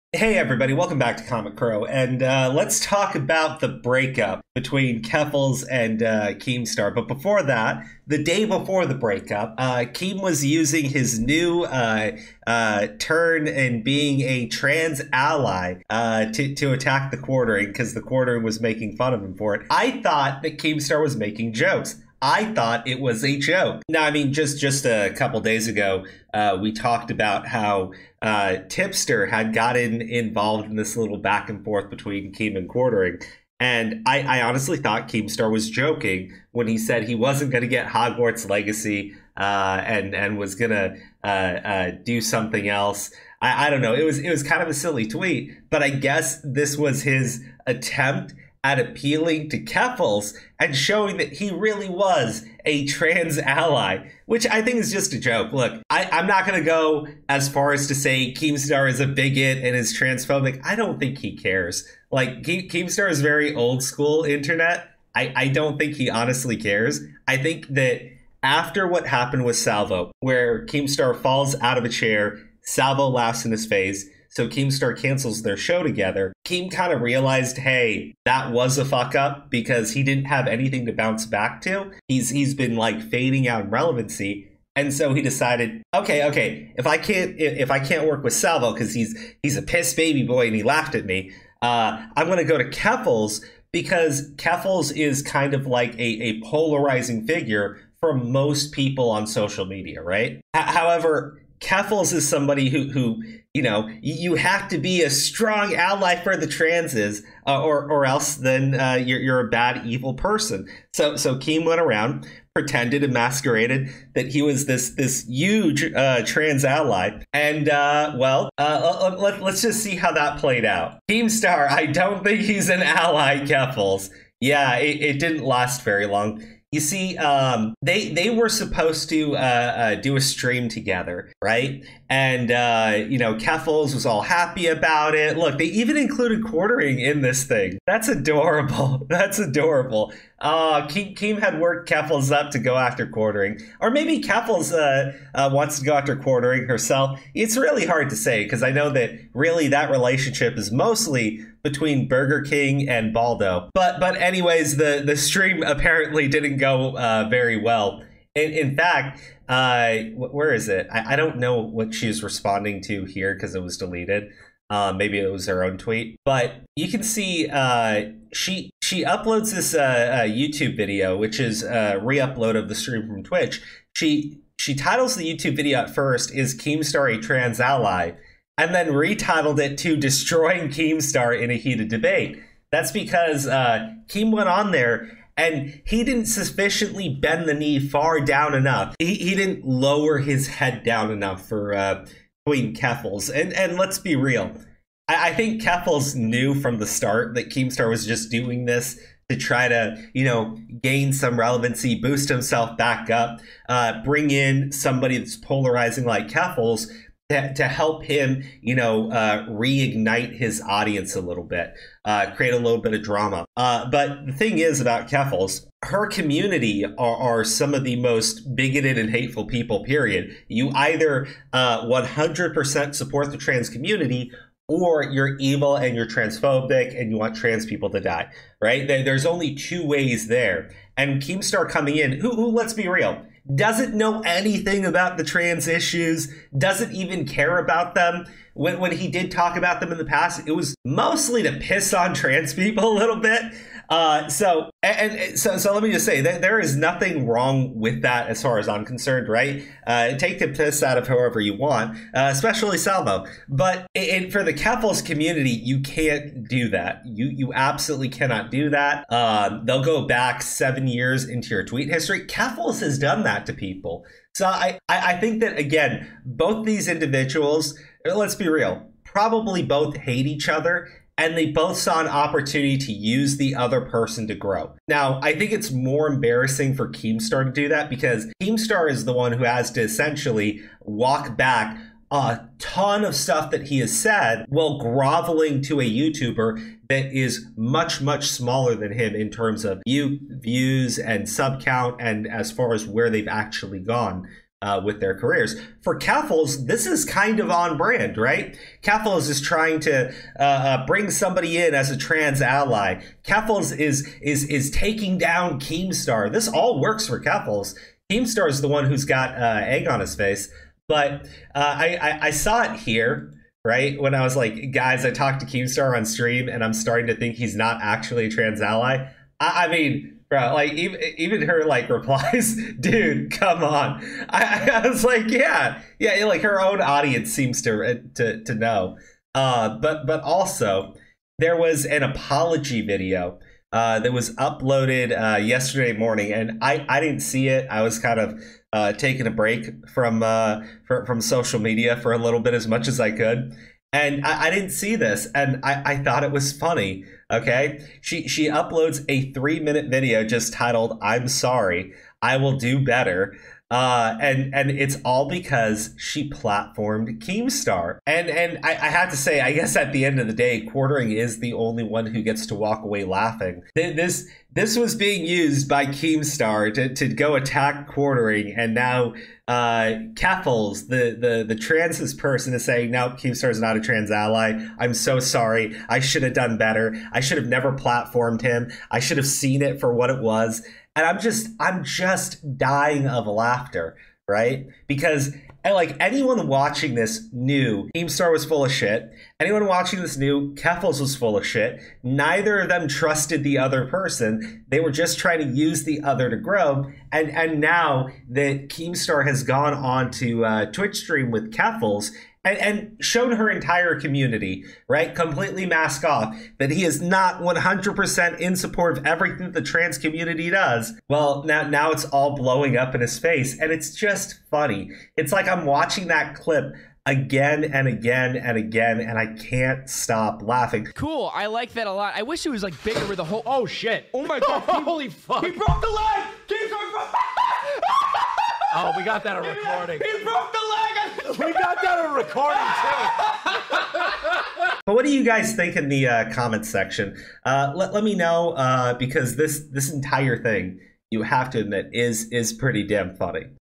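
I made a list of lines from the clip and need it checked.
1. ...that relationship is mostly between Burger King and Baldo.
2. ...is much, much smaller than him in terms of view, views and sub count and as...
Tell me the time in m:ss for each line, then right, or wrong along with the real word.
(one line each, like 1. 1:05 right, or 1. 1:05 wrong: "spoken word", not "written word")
1. 2:29 right
2. 4:47 right.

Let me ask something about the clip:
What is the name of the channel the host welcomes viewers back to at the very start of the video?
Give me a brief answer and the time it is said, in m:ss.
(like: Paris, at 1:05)
Comic Crow, at 0:01.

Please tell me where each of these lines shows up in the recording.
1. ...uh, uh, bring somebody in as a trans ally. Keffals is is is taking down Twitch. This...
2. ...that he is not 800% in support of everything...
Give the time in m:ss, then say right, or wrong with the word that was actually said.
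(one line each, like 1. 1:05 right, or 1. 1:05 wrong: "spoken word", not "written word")
1. 5:00 wrong: "Keemstar", not "Twitch"
2. 6:46 wrong: "100", not "800".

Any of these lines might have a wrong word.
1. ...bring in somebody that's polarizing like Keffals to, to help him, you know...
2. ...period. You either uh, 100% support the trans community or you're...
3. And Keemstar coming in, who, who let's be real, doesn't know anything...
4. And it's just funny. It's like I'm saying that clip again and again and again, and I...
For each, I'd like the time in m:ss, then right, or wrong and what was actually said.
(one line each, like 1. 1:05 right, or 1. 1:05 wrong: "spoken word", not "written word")
1. 3:24 right
2. 3:39 right
3. 3:50 right
4. 6:53 wrong: "watching", not "saying".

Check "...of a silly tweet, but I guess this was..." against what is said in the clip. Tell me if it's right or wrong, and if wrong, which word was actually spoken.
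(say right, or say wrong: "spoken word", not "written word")
right.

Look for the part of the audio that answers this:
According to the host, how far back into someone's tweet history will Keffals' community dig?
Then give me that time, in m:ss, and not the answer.
4:20.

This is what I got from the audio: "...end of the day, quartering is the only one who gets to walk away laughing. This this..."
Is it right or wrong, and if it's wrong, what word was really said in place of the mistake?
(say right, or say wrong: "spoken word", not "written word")
right.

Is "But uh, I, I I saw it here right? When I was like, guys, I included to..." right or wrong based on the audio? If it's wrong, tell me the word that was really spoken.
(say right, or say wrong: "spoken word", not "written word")
wrong: "talked", not "included".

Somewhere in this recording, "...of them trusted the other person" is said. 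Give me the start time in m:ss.
6:32.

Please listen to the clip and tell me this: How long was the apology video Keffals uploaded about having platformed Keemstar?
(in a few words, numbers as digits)
3 minutes.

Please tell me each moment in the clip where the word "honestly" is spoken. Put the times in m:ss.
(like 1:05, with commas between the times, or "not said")
0:34, 1:06.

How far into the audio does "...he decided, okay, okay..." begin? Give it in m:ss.
1:25.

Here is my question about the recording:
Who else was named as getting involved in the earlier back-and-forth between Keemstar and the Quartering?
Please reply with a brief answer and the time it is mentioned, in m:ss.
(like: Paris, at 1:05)
Tipster, at 0:28.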